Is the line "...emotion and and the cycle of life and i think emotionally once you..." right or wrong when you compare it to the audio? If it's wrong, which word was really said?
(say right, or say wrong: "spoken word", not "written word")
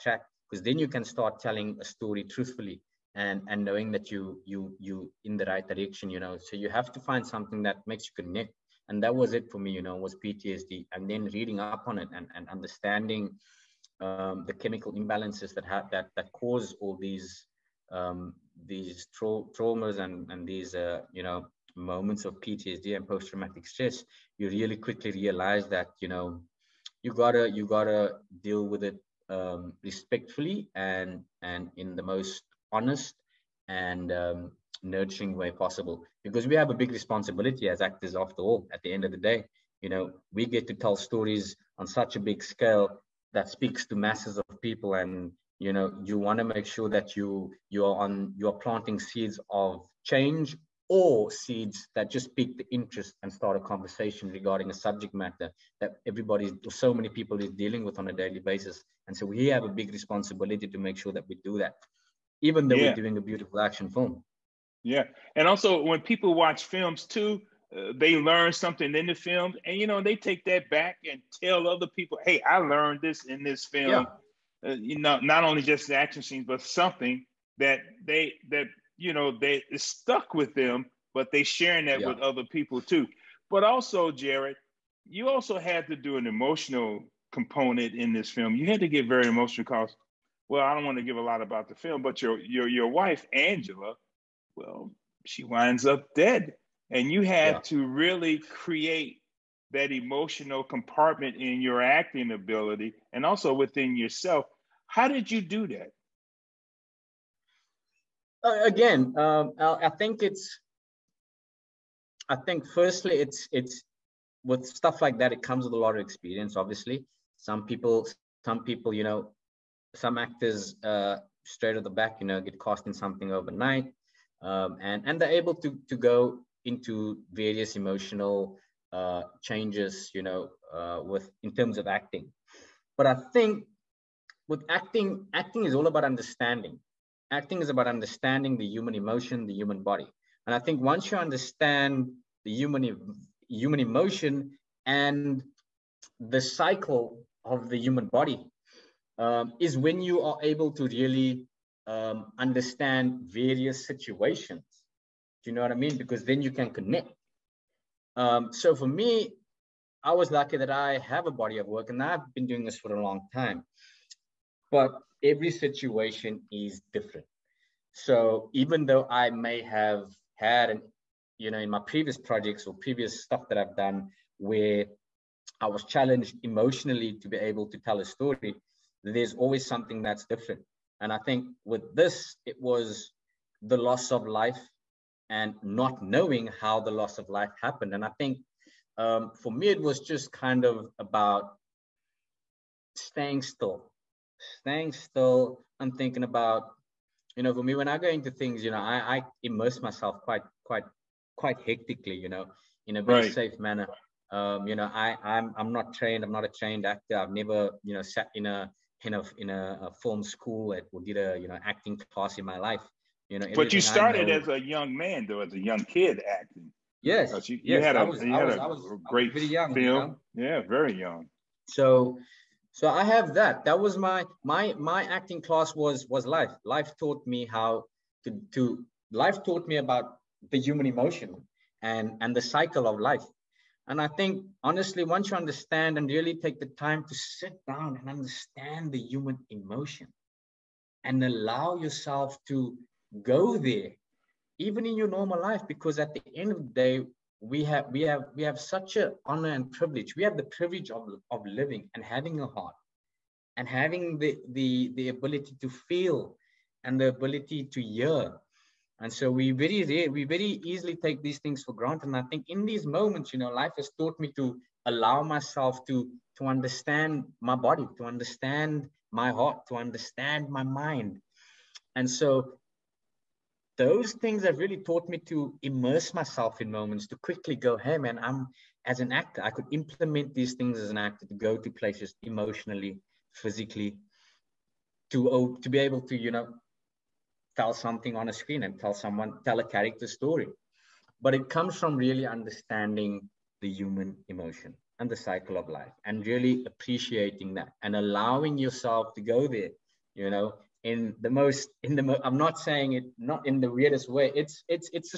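wrong: "honestly", not "emotionally".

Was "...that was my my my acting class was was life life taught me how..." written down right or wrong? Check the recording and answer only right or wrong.
right.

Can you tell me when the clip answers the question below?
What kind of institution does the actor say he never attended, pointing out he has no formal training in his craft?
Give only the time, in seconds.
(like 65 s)
210 s.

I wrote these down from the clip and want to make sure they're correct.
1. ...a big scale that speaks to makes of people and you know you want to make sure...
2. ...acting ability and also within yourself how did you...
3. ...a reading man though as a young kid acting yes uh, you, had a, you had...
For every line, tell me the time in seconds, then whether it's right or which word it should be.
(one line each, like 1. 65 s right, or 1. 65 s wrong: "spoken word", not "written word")
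1. 42 s wrong: "masses", not "makes"
2. 101 s right
3. 214 s wrong: "young", not "reading".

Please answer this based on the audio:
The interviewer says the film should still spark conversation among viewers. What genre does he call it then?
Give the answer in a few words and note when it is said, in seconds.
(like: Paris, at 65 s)
action film, at 63 s.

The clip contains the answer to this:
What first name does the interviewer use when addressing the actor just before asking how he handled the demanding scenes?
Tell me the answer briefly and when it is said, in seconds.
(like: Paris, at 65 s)
Jarrid, at 84 s.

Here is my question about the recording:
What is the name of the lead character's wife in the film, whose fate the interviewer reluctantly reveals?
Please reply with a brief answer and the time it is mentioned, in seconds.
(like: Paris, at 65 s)
Angela, at 93 s.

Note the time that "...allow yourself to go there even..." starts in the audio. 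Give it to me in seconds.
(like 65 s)
241 s.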